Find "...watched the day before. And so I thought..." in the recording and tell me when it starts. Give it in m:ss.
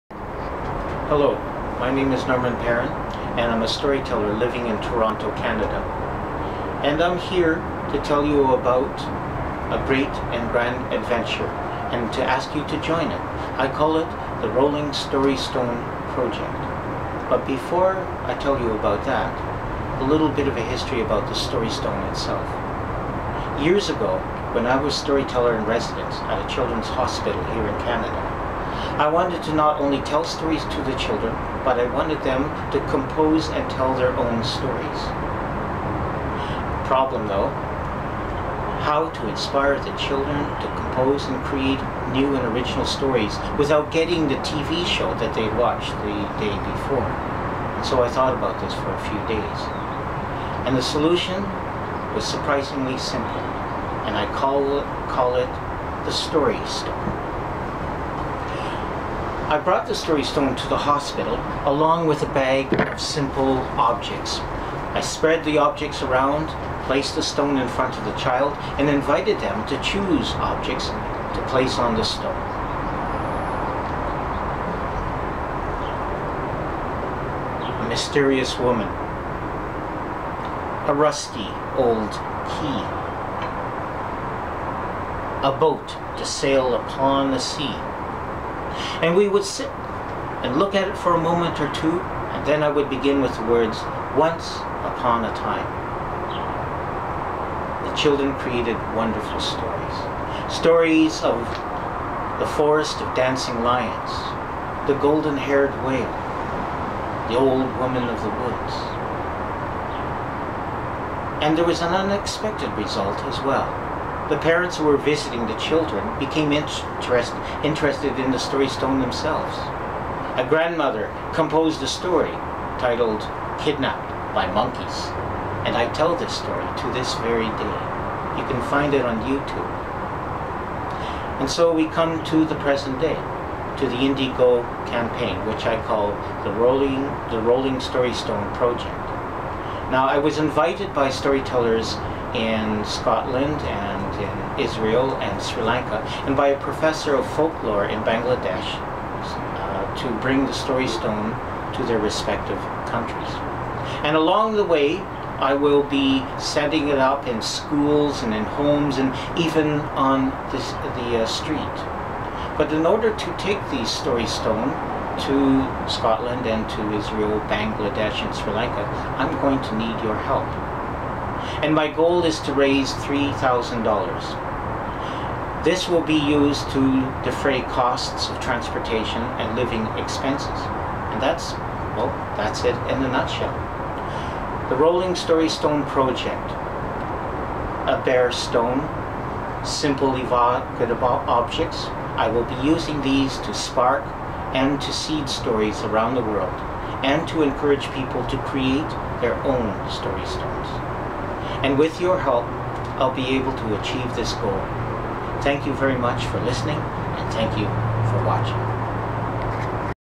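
0:45.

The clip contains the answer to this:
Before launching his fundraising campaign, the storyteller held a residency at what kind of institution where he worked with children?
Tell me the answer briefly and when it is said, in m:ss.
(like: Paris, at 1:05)
children's hospital, at 0:26.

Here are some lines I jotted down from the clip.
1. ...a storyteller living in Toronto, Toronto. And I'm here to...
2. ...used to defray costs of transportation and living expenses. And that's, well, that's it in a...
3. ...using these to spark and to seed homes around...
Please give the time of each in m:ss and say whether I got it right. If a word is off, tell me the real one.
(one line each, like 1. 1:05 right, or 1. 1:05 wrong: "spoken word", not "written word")
1. 0:03 wrong: "Canada", not "Toronto"
2. 2:56 right
3. 3:12 wrong: "stories", not "homes".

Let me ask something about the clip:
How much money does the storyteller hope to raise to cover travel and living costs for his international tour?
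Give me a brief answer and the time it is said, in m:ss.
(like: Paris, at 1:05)
$3,000, at 2:52.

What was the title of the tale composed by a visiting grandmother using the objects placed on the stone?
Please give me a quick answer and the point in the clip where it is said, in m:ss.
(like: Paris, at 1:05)
Kidnapped by Monkeys, at 2:03.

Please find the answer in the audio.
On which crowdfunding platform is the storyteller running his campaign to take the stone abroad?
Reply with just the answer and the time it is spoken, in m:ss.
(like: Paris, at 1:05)
Indiegogo, at 2:13.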